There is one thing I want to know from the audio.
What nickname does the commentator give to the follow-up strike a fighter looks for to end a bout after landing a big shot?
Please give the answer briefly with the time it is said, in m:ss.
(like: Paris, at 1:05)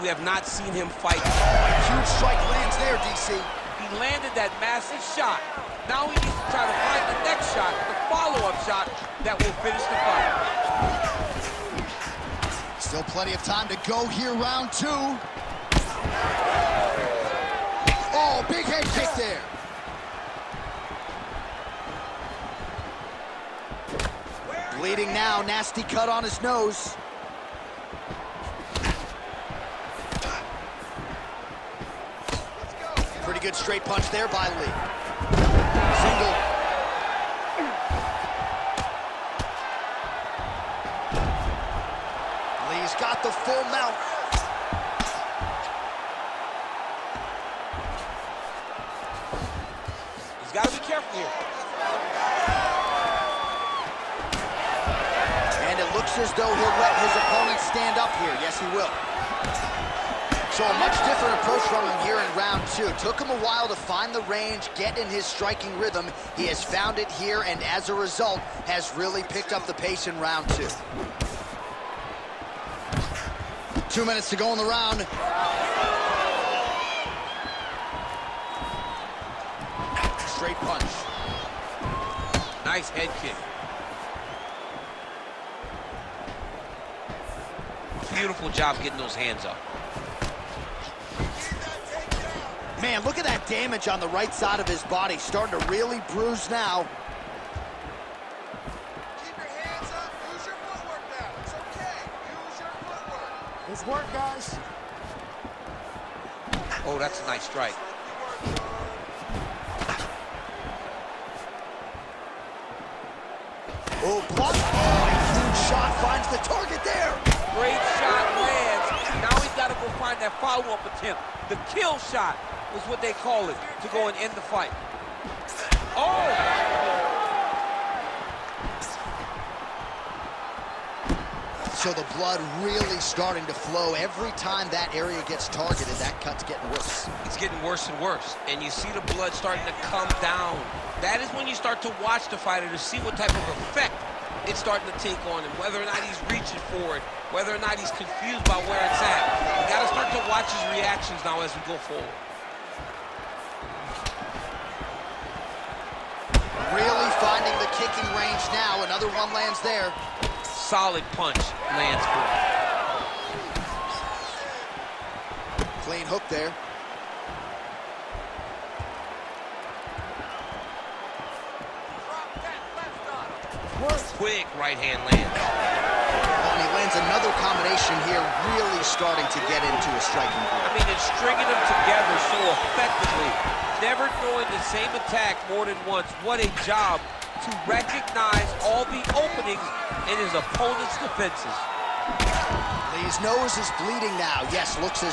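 the kill shot, at 2:01.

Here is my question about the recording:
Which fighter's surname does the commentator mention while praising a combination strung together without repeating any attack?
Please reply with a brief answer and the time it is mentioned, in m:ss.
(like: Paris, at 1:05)
Jones, at 2:56.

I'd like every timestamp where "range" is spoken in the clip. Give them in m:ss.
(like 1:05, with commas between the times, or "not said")
1:04, 2:38.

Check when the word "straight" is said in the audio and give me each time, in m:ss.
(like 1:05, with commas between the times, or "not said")
0:33, 1:20.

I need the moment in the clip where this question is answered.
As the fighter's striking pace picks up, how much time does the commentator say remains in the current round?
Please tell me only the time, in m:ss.
1:13.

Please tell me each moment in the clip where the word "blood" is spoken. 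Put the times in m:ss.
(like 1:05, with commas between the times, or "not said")
2:12, 2:19.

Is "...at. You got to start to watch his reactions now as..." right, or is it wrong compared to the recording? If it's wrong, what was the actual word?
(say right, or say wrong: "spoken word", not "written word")
right.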